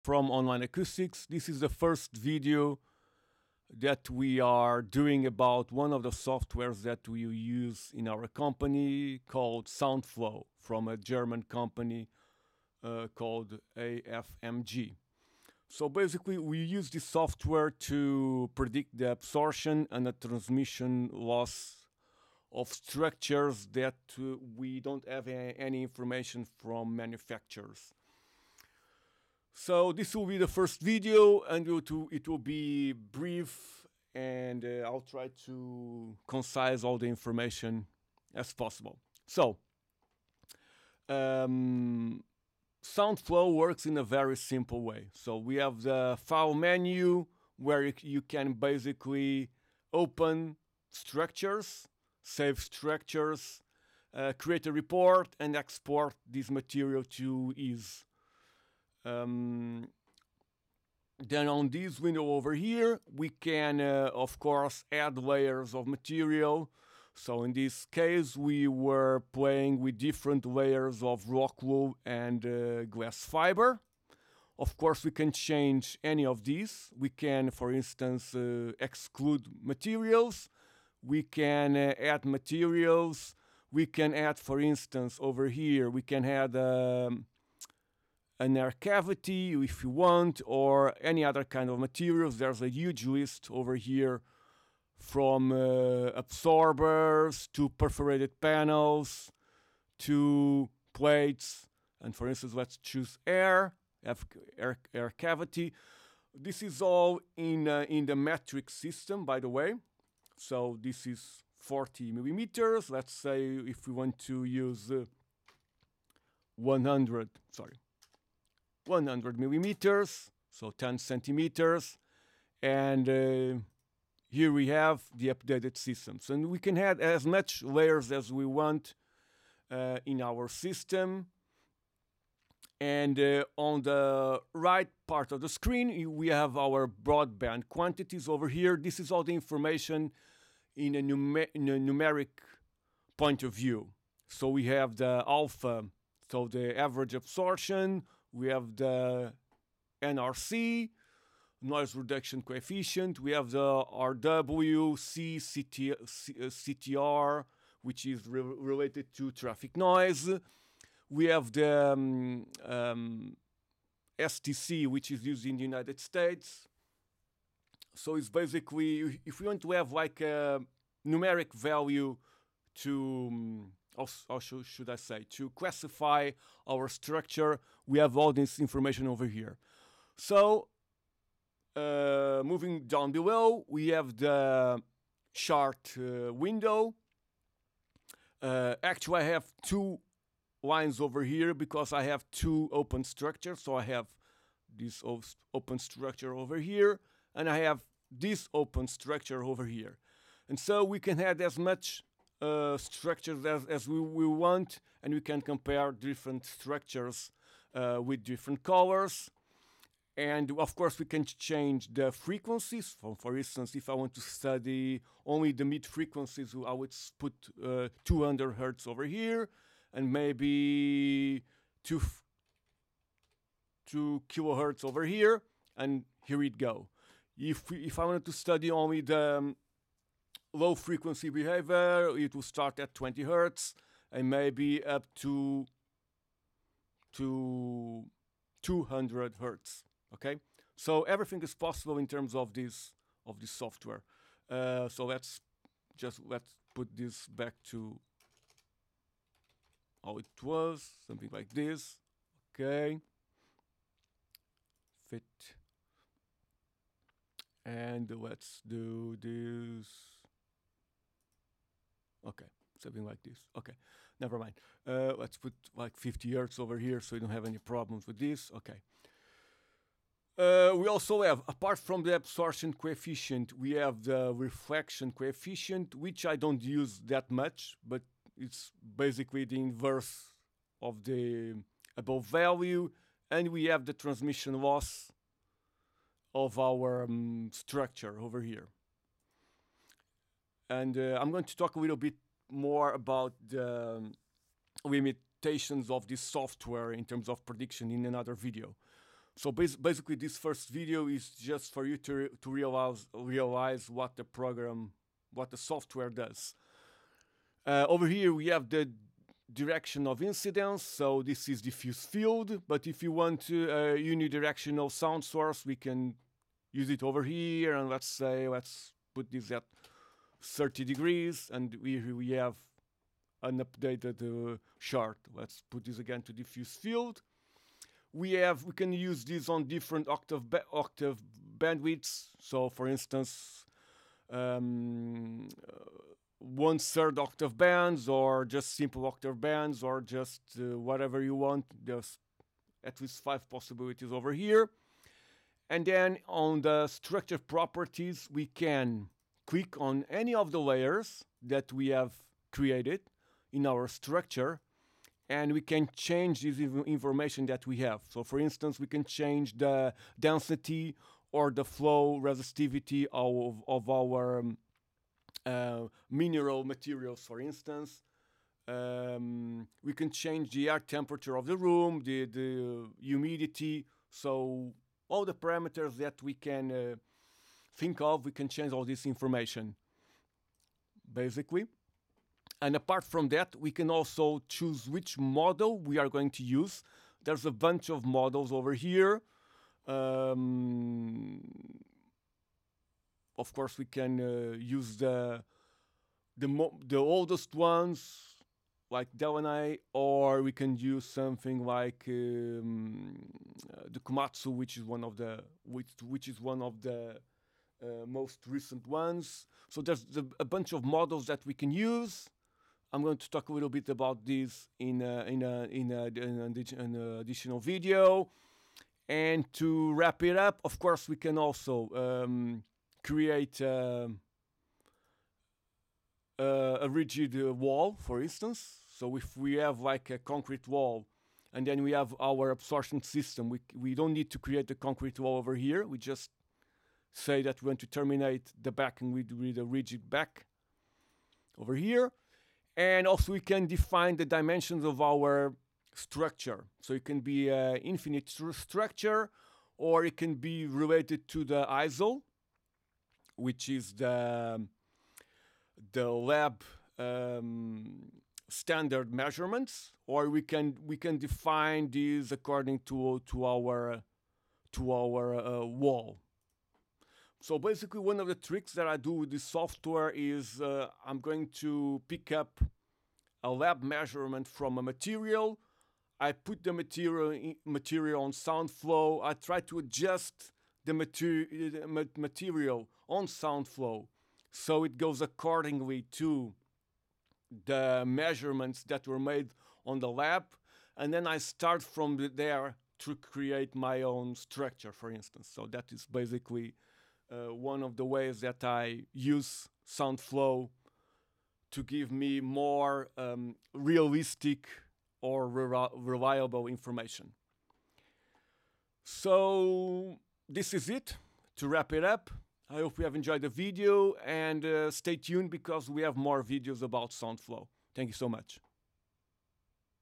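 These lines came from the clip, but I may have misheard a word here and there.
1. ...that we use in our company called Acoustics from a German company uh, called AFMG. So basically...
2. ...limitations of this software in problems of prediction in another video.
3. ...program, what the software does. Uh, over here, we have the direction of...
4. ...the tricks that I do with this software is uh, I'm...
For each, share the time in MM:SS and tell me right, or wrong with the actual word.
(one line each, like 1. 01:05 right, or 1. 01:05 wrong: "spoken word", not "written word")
1. 00:06 wrong: "Soundflow", not "Acoustics"
2. 04:54 wrong: "terms", not "problems"
3. 05:04 right
4. 07:48 right.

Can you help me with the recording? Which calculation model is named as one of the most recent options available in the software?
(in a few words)
Komatsu.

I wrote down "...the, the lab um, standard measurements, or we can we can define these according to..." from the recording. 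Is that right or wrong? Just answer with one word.
right.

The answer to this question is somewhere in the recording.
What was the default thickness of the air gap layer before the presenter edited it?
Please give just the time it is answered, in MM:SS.
01:51.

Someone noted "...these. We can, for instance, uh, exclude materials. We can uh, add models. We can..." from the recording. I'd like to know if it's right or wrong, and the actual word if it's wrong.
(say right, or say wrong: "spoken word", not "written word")
wrong: "materials", not "models".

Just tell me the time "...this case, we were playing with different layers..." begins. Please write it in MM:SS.
01:07.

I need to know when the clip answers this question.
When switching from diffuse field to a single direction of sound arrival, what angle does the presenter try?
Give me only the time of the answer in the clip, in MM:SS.
05:20.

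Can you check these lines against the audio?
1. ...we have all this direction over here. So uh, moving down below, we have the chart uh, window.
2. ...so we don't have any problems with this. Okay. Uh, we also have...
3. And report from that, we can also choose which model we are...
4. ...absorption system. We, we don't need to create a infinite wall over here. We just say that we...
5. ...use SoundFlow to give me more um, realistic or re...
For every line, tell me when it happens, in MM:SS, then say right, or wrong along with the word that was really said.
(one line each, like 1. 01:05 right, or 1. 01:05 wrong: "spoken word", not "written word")
1. 02:57 wrong: "information", not "direction"
2. 04:27 right
3. 06:22 wrong: "apart", not "report"
4. 07:12 wrong: "concrete", not "infinite"
5. 08:19 right.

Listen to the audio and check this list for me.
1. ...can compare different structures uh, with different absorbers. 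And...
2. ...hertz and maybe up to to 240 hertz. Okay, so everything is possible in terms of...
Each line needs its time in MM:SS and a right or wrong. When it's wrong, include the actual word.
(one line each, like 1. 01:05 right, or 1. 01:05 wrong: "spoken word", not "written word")
1. 03:25 wrong: "colors", not "absorbers"
2. 03:53 wrong: "200", not "240".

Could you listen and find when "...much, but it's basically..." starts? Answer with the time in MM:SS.
04:37.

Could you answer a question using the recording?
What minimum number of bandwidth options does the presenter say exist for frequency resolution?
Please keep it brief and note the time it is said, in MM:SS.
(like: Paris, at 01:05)
5, at 05:43.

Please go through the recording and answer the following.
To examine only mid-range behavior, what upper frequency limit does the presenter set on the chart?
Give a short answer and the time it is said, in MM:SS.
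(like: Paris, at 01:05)
2 kilohertz, at 03:43.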